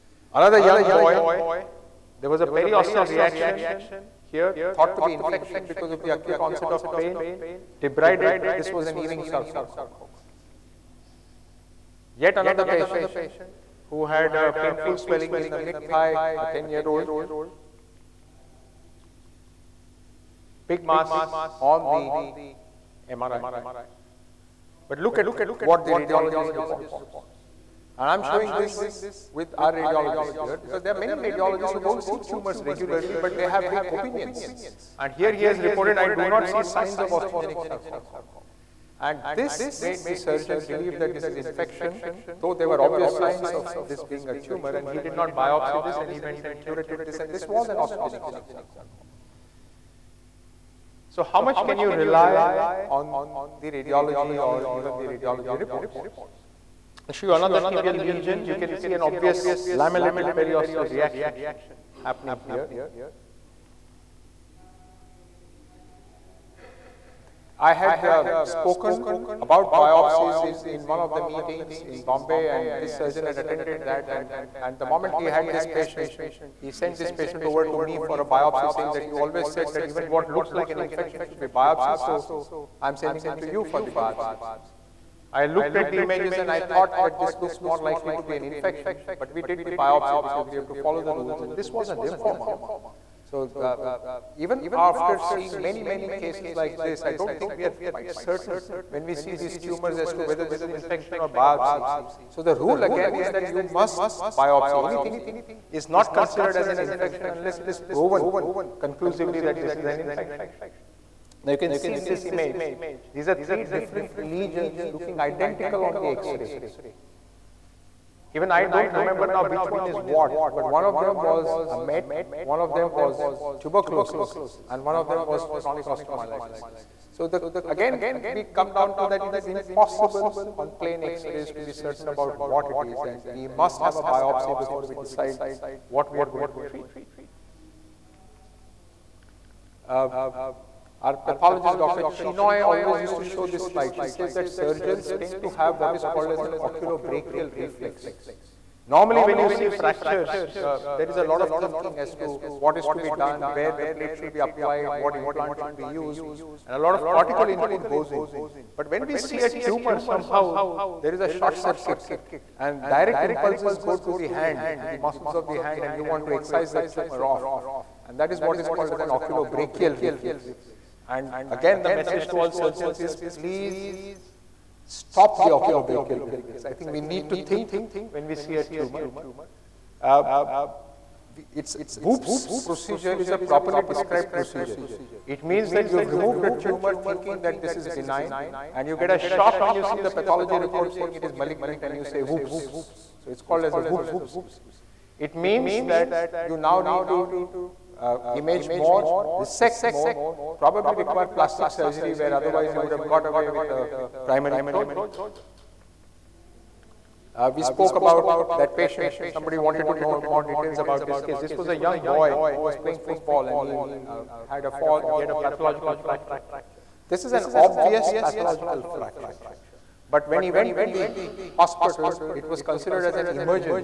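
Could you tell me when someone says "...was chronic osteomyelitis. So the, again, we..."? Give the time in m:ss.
2:05.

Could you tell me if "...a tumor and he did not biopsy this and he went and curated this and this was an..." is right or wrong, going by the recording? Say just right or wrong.
right.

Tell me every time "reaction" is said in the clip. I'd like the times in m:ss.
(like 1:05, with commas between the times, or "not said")
0:03, 1:00.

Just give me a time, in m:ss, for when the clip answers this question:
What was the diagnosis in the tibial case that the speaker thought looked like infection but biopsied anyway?
1:31.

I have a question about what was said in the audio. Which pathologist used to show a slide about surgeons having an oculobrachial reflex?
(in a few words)
Dr. Chinoy.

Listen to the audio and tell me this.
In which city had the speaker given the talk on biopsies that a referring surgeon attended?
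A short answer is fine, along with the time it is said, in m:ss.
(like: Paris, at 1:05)
Bombay, at 1:12.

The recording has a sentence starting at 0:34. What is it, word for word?
And here he has reported, I do not see signs of osteogenic sarcoma.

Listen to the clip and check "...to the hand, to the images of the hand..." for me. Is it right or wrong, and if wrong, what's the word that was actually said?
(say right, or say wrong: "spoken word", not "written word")
wrong: "muscles", not "images".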